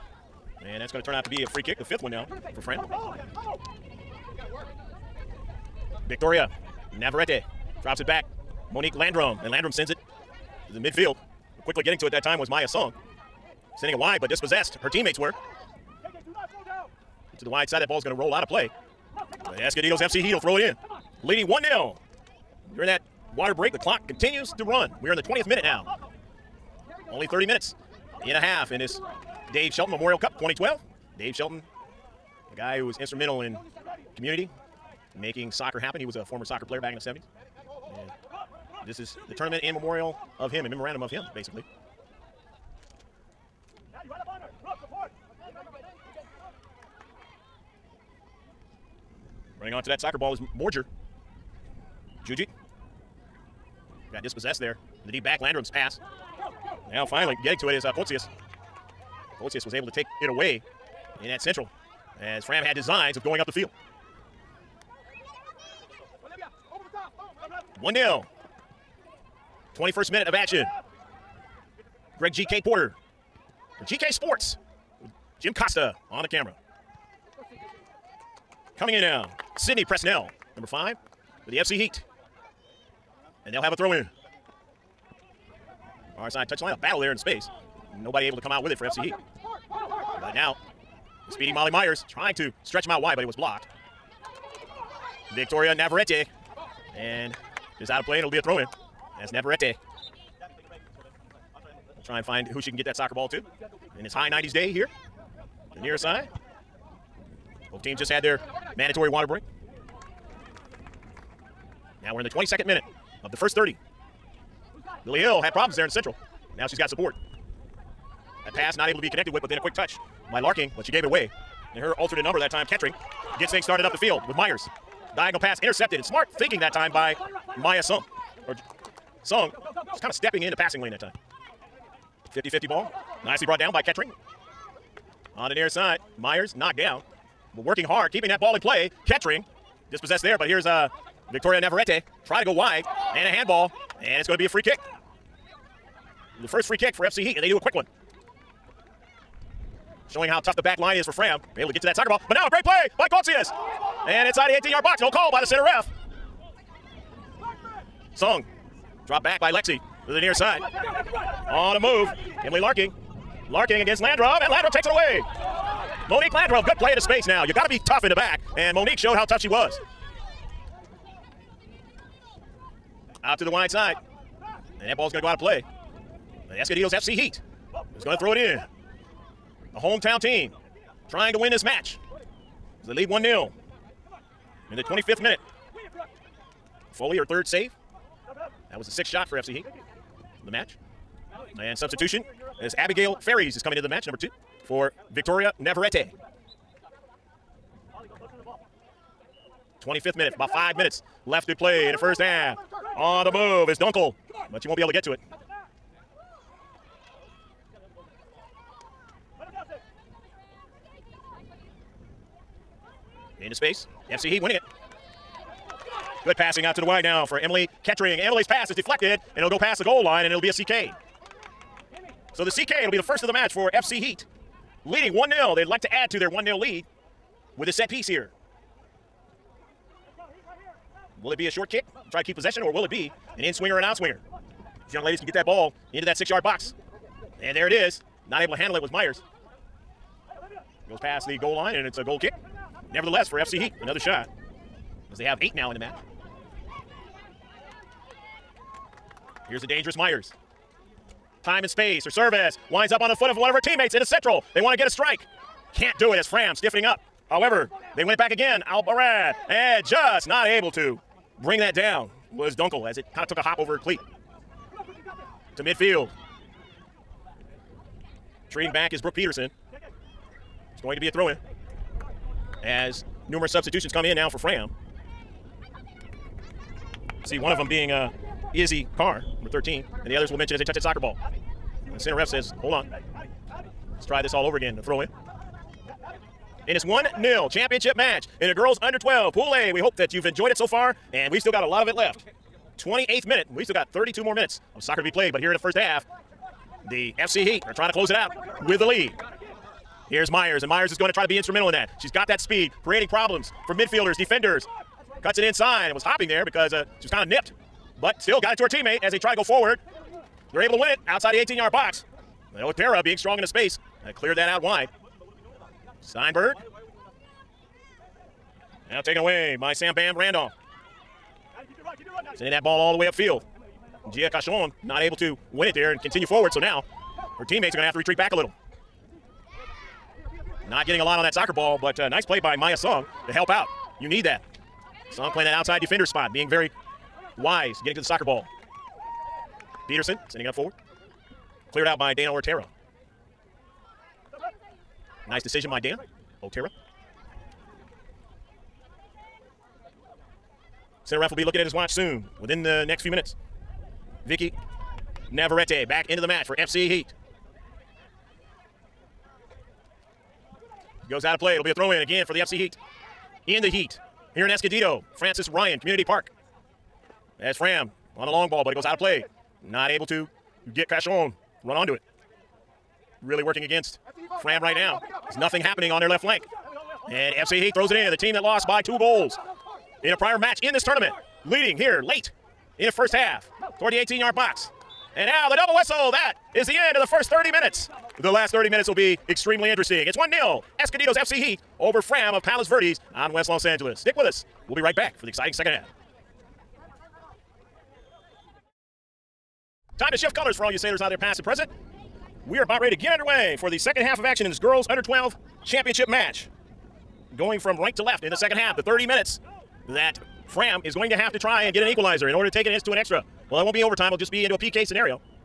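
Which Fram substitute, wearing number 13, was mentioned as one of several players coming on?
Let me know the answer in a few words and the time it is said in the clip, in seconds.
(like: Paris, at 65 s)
Izzy Carr, at 278 s.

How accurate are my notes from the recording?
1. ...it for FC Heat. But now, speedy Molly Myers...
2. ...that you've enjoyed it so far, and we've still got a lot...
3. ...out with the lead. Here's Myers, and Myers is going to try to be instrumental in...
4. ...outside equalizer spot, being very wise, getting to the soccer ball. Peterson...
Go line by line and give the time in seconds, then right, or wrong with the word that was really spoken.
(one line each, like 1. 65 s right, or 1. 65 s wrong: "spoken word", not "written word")
1. 88 s right
2. 289 s right
3. 298 s right
4. 335 s wrong: "defender", not "equalizer".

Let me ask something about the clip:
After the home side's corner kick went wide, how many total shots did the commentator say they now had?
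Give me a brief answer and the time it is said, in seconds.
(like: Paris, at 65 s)
8, at 245 s.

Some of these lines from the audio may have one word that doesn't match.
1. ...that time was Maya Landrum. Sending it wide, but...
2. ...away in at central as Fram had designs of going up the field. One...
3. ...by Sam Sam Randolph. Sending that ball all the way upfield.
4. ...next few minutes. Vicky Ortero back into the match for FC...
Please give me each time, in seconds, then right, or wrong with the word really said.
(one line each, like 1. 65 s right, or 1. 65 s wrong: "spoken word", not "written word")
1. 12 s wrong: "Song", not "Landrum"
2. 60 s right
3. 319 s wrong: "Bam", not "Sam"
4. 352 s wrong: "Navarrete", not "Ortero".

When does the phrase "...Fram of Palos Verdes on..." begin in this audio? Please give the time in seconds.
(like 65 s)
392 s.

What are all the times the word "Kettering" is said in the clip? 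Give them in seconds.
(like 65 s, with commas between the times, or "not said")
122 s, 133 s, 139 s, 217 s.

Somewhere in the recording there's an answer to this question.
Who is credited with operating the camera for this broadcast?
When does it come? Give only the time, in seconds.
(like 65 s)
75 s.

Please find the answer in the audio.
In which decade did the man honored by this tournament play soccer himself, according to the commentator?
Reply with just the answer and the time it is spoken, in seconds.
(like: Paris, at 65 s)
1970s, at 36 s.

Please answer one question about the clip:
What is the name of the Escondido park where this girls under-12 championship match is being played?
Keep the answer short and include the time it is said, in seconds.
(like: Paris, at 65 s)
Frances Ryan Community Park, at 365 s.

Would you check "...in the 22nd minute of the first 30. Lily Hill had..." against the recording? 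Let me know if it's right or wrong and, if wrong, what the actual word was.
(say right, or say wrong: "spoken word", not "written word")
right.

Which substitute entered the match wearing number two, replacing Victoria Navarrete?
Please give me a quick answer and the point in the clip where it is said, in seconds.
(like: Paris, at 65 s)
Abigail Ferris, at 192 s.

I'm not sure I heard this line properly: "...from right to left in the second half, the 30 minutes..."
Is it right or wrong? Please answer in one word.
right.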